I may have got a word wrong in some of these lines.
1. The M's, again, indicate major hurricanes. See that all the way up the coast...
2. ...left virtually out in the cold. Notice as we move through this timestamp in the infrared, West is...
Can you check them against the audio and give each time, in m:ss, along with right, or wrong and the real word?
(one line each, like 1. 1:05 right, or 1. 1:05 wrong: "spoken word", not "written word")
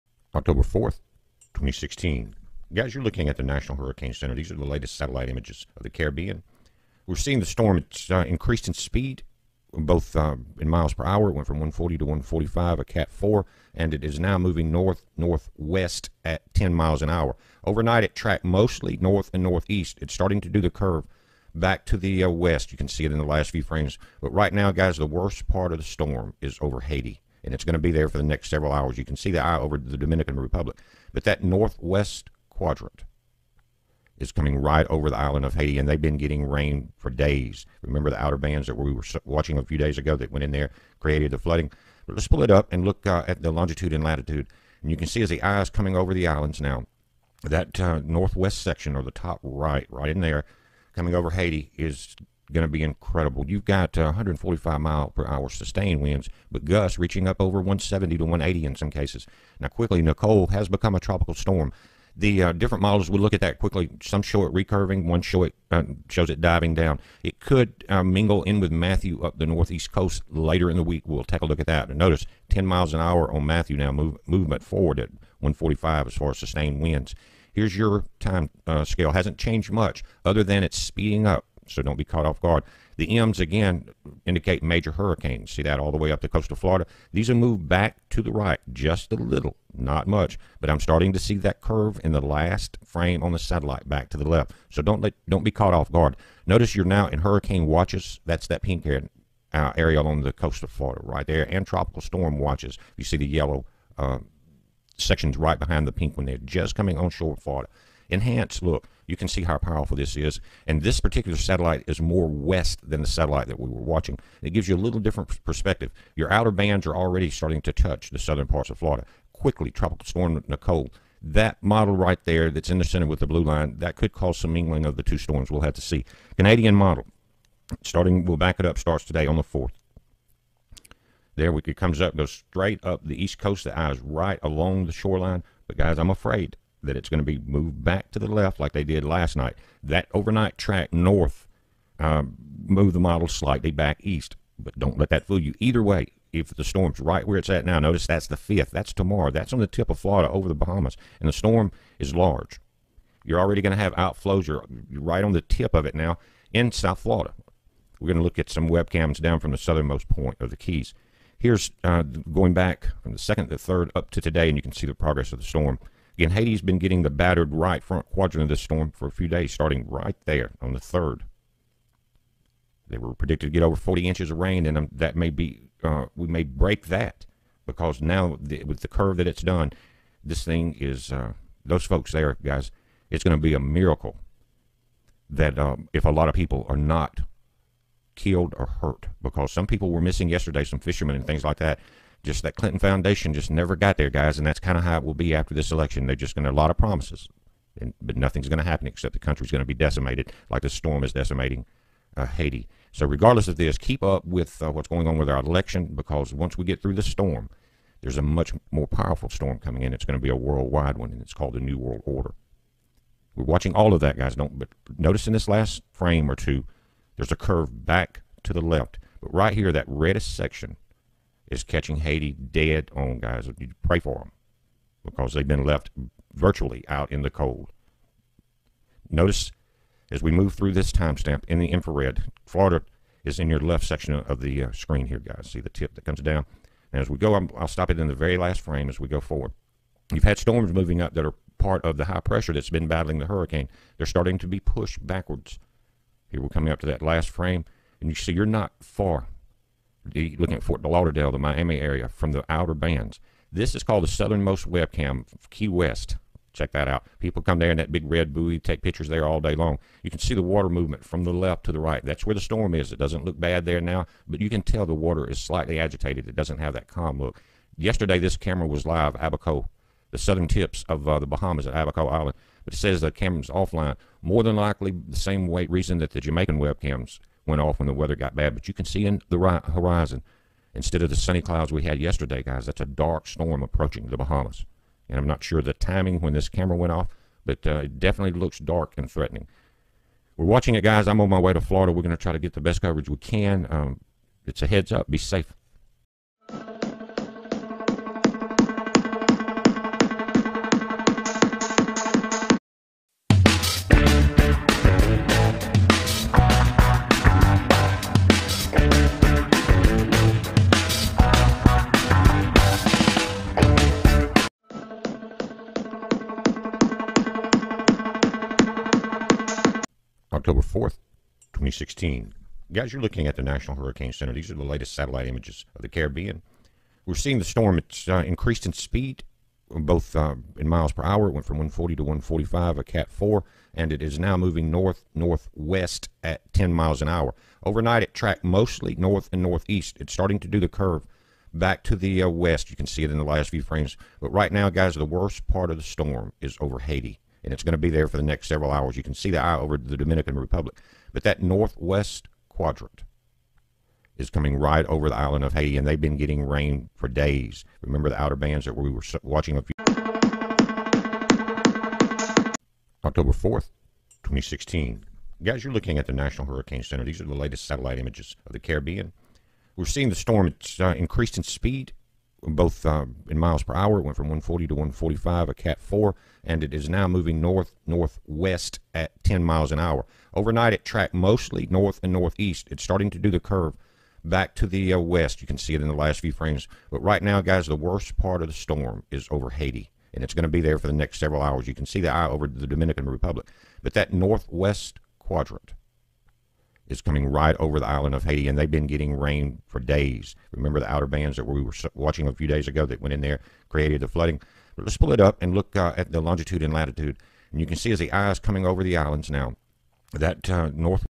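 1. 1:22 right
2. 3:45 wrong: "Florida", not "West".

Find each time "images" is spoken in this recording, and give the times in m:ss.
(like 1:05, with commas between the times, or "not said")
0:05, 5:25, 6:07.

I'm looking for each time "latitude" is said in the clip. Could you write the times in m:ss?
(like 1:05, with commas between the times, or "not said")
0:44, 6:46.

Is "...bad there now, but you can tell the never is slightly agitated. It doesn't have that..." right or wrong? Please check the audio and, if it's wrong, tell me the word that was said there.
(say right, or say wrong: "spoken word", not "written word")
wrong: "water", not "never".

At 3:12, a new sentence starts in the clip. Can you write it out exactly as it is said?
Just that Clinton Foundation just never got there, guys, and that's kind of how it will be after this election.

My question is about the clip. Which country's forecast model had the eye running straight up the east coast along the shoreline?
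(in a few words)
Canadian model.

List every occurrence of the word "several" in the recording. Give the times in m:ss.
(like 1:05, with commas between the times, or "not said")
0:28, 5:48, 6:31.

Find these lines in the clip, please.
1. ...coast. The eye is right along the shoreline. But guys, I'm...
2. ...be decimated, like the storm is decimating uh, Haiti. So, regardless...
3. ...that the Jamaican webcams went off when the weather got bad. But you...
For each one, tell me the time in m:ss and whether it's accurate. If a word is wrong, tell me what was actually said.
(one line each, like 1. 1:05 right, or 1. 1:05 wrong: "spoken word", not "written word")
1. 2:13 right
2. 3:19 right
3. 4:35 right.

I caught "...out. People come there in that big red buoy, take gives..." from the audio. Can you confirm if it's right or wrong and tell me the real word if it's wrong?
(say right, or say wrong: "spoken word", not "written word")
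wrong: "pictures", not "gives".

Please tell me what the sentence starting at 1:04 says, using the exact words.
Some show it recurving, one show it, uh, shows it diving down.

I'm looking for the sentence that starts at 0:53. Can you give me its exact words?
You've got uh, 145 mile per hour sustained winds, but gusts reaching up over 170 to 180 in some cases.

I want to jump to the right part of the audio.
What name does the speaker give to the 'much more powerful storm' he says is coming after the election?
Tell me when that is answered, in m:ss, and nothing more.
3:31.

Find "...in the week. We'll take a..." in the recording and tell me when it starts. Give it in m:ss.
1:10.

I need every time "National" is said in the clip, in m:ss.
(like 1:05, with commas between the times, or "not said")
0:03, 5:23, 6:06.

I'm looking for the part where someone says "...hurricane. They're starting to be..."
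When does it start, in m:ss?
4:03.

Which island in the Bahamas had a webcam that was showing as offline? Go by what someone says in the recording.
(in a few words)
Abaco Island.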